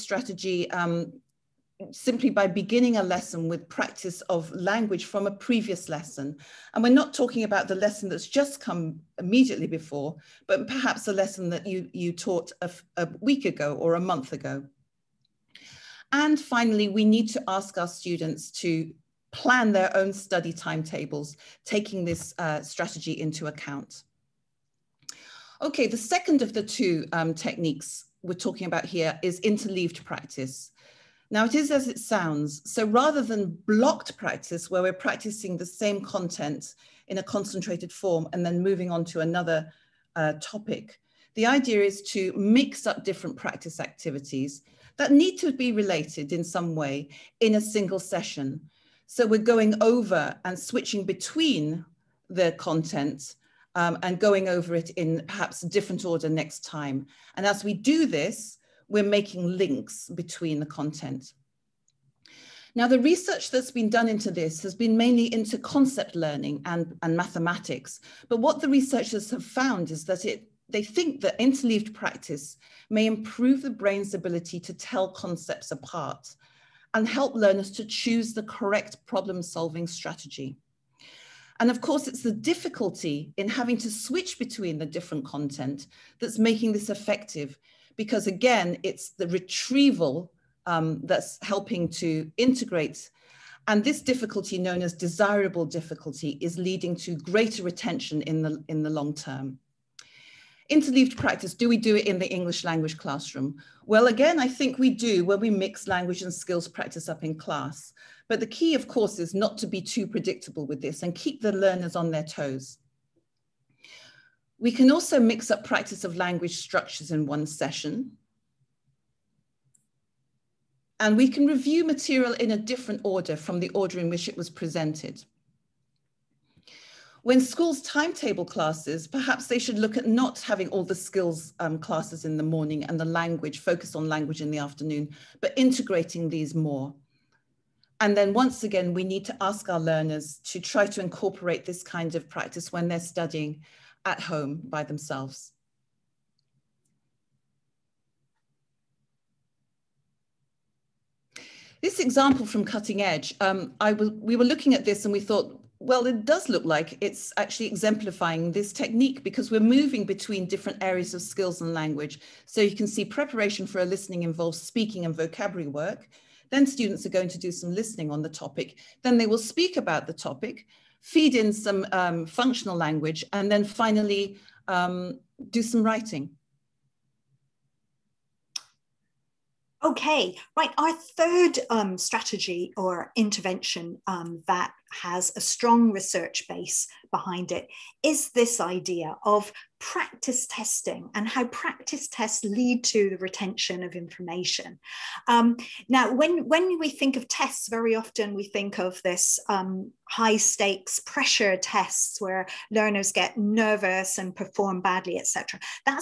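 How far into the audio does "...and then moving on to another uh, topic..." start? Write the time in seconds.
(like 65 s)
38 s.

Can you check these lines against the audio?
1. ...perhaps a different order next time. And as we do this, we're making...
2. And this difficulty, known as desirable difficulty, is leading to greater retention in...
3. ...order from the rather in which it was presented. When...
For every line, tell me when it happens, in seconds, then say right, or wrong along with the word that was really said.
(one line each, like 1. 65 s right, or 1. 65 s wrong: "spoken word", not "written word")
1. 55 s right
2. 93 s right
3. 123 s wrong: "order", not "rather".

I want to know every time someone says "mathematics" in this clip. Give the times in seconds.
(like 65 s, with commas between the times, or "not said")
67 s.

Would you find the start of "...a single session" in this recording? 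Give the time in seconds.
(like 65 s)
47 s.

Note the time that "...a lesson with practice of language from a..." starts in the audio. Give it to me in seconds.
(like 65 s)
2 s.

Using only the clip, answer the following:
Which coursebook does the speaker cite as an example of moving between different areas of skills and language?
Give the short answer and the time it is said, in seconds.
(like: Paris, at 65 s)
Cutting Edge, at 152 s.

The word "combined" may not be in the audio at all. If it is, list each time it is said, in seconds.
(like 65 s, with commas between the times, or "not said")
not said.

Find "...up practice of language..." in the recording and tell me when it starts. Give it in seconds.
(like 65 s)
115 s.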